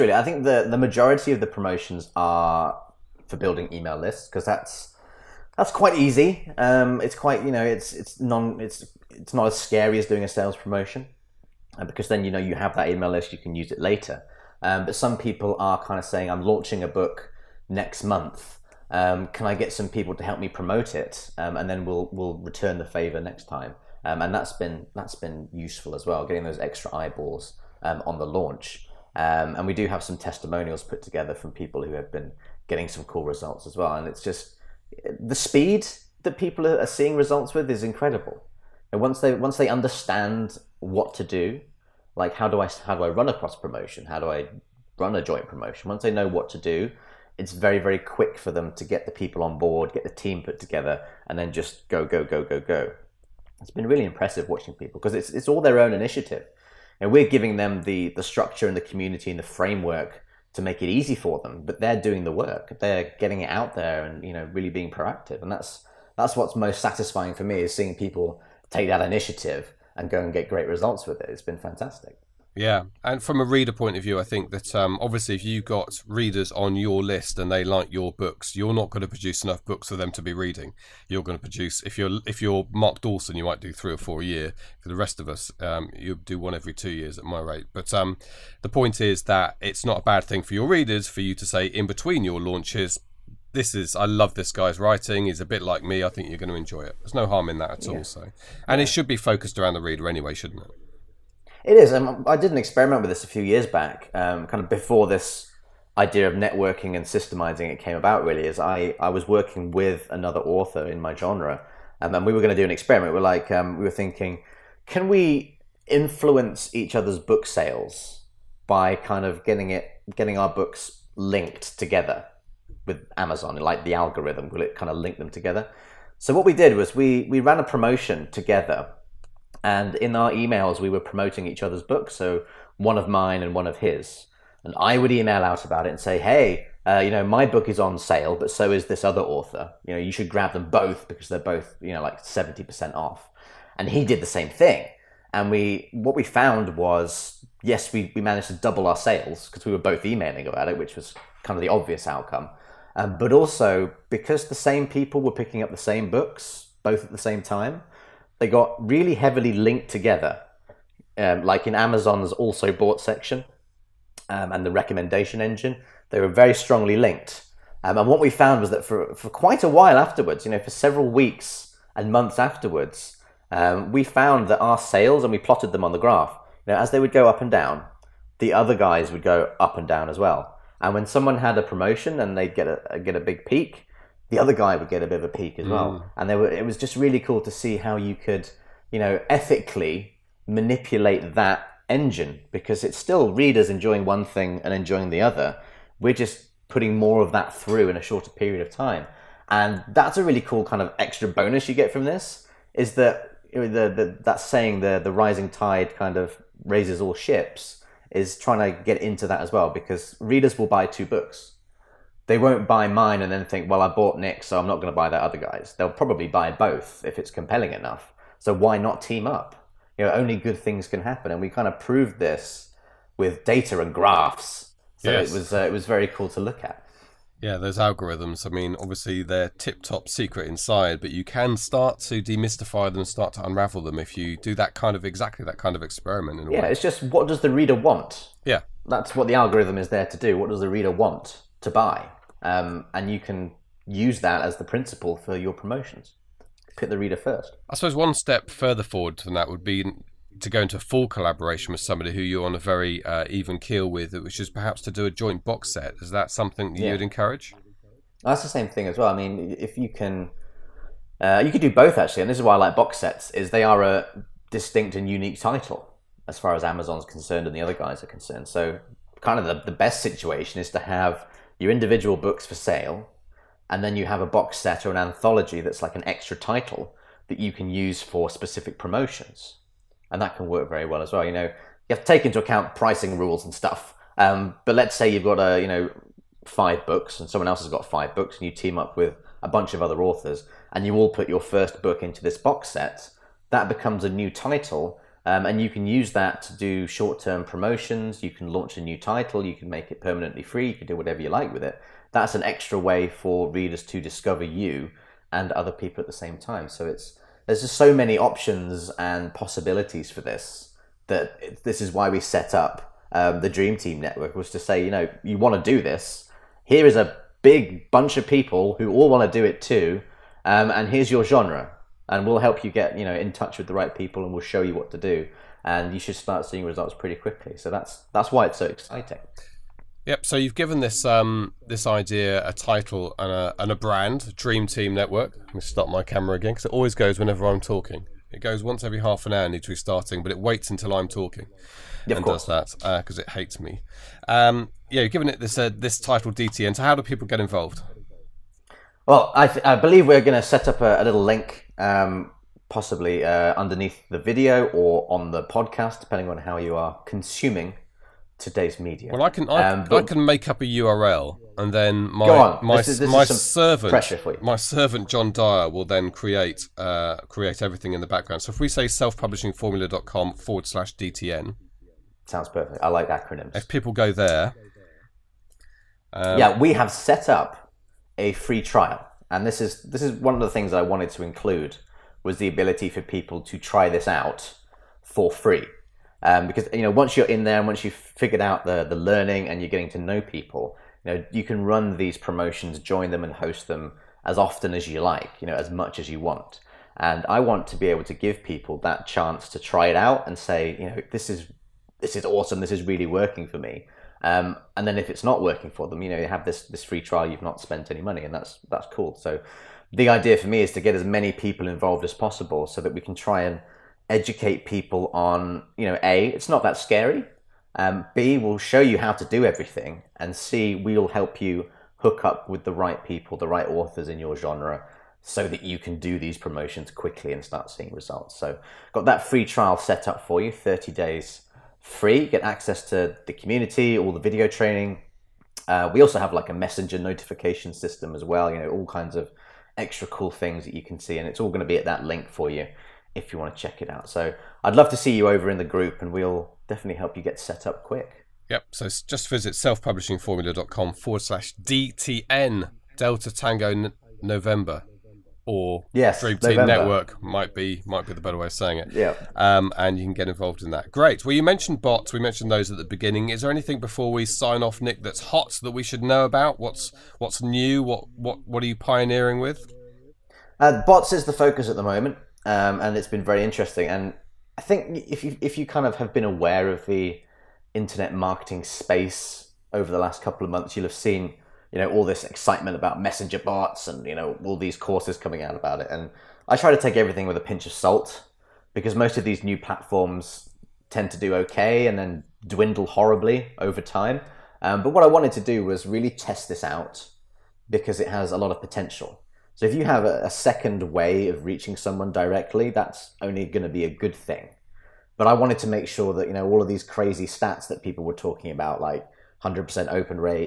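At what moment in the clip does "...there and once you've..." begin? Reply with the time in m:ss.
6:27.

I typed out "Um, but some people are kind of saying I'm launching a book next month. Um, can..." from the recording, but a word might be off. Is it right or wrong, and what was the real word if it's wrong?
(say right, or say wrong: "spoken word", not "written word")
right.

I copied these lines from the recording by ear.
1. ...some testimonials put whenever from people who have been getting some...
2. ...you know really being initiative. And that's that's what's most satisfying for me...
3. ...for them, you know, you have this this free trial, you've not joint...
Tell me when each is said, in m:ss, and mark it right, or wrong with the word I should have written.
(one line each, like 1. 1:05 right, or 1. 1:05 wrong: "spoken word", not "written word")
1. 0:30 wrong: "together", not "whenever"
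2. 1:04 wrong: "proactive", not "initiative"
3. 6:45 wrong: "spent", not "joint".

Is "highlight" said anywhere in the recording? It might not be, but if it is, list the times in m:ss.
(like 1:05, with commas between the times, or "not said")
not said.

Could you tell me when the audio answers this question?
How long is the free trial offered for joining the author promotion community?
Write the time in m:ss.
7:10.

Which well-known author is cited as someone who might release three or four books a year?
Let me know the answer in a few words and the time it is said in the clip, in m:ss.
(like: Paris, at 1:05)
Mark Dawson, at 1:22.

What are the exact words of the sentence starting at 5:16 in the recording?
Here is a big bunch of people who all want to do it too.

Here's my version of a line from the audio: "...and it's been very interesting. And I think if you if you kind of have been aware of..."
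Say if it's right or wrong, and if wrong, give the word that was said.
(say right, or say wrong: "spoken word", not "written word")
right.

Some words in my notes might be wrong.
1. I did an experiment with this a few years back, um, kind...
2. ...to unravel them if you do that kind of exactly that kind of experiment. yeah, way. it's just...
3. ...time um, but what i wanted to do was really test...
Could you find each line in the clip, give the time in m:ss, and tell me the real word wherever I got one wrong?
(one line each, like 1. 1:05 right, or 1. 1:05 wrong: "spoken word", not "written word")
1. 1:41 right
2. 3:53 right
3. 8:13 right.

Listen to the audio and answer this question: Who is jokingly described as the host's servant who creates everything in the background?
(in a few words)
John Dyer.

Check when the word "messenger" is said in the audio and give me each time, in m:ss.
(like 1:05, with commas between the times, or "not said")
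7:16, 8:03.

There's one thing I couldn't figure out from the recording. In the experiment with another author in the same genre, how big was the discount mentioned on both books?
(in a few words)
70%.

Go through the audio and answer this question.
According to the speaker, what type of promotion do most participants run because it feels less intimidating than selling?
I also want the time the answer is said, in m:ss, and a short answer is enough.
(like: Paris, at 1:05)
Building email lists, at 0:03.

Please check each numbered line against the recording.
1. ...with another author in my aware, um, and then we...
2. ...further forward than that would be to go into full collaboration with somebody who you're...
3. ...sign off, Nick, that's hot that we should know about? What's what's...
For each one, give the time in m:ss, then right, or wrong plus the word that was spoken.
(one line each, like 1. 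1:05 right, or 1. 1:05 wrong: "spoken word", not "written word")
1. 1:49 wrong: "genre", not "aware"
2. 4:08 right
3. 7:44 right.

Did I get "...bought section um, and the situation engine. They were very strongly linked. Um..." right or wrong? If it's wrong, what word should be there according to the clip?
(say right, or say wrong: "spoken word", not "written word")
wrong: "recommendation", not "situation".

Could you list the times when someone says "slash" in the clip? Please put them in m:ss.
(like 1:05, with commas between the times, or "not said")
6:10, 7:31.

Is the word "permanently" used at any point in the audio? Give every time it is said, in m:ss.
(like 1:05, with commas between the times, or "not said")
5:00.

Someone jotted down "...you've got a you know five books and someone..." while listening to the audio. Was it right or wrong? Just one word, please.
right.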